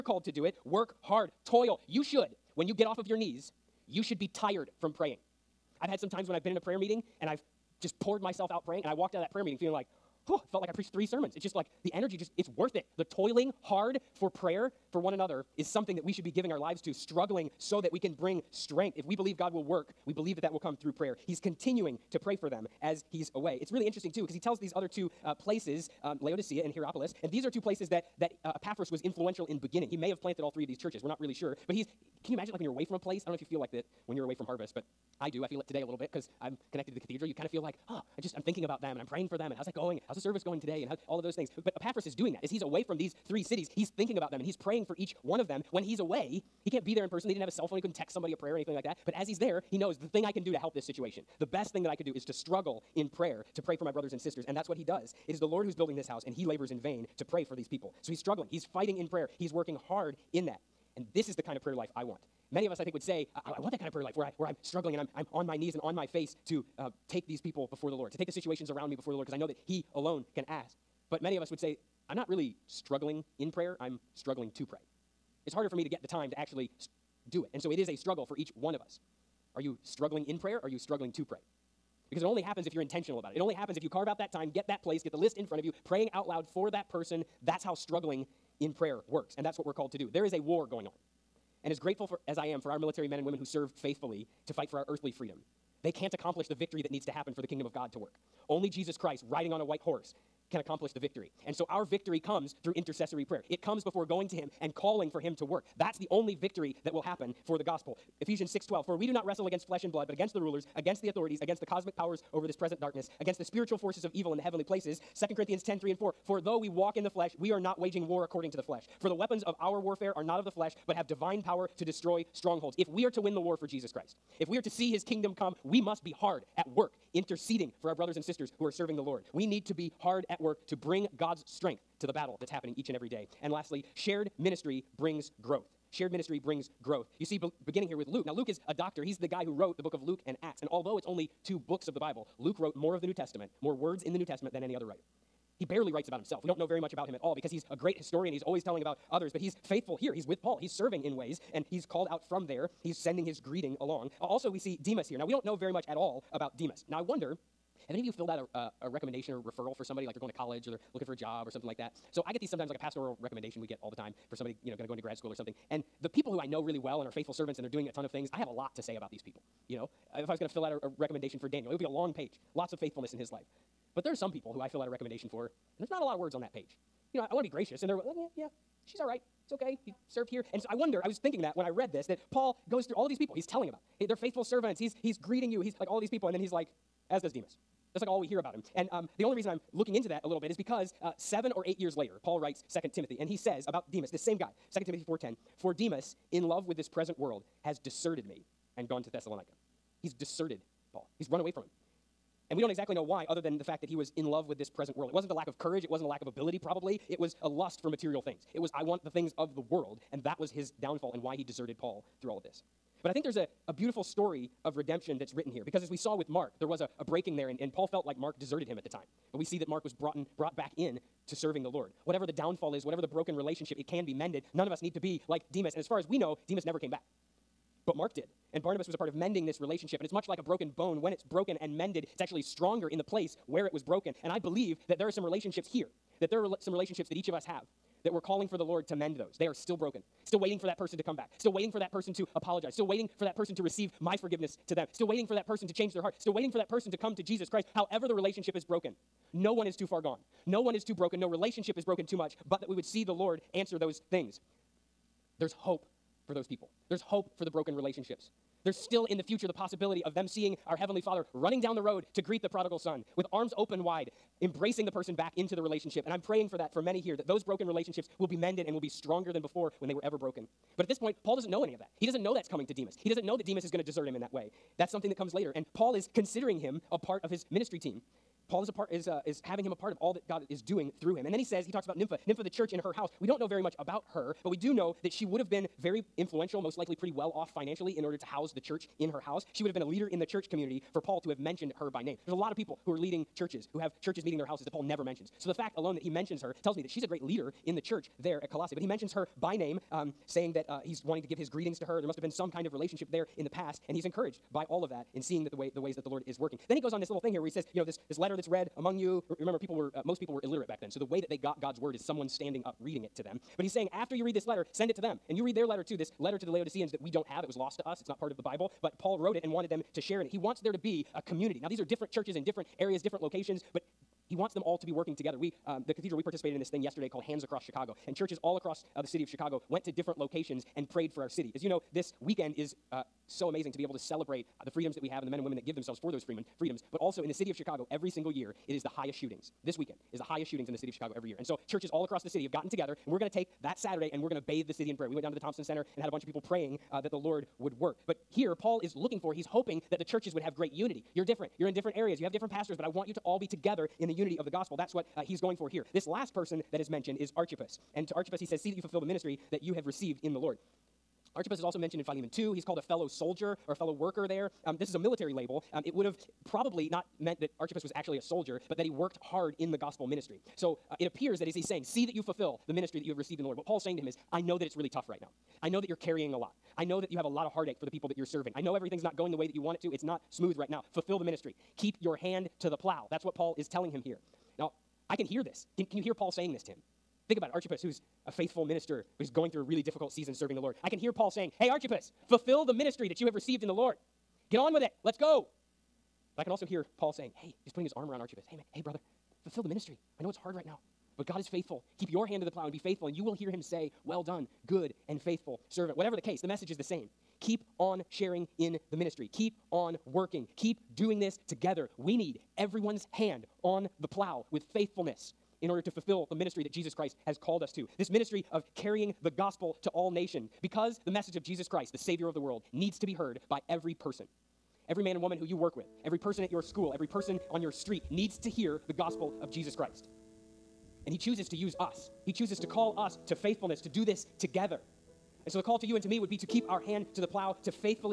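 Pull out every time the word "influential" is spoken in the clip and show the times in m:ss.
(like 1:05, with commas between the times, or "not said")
0:29, 4:46.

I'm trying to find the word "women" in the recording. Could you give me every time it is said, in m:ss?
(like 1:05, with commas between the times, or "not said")
1:33, 5:35.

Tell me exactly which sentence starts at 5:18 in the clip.
It's not part of the Bible, but Paul wrote it and wanted them to share in it.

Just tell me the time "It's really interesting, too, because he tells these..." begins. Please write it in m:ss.
0:23.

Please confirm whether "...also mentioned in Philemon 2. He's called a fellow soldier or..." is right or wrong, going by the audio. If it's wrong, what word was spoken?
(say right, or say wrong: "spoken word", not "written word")
right.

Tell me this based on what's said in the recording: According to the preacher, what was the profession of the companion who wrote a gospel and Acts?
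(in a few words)
doctor.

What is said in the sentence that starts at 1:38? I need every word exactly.
Only Jesus Christ riding on a white horse can accomplish the victory.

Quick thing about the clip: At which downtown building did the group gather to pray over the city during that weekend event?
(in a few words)
Thompson Center.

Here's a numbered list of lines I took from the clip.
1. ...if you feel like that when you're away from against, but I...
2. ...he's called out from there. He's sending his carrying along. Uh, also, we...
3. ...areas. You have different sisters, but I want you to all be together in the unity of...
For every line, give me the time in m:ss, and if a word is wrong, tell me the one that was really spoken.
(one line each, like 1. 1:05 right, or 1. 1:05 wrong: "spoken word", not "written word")
1. 0:33 wrong: "harvest", not "against"
2. 2:31 wrong: "greeting", not "carrying"
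3. 5:51 wrong: "pastors", not "sisters".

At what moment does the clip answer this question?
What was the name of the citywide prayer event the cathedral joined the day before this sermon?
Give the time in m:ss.
5:27.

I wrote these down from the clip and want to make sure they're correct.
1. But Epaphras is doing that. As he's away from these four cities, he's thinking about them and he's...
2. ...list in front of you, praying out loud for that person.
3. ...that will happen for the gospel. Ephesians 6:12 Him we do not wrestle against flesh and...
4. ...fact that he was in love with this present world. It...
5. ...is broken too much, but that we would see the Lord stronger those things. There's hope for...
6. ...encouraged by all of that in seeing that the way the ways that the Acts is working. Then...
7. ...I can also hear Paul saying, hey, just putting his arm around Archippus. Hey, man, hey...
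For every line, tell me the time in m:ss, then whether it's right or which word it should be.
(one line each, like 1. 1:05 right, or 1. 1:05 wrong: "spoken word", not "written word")
1. 0:41 wrong: "three", not "four"
2. 1:25 right
3. 1:46 wrong: "For", not "Him"
4. 3:23 right
5. 4:11 wrong: "answer", not "stronger"
6. 5:04 wrong: "Lord", not "Acts"
7. 6:36 right.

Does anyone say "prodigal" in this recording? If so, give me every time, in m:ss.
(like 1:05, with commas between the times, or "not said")
4:22.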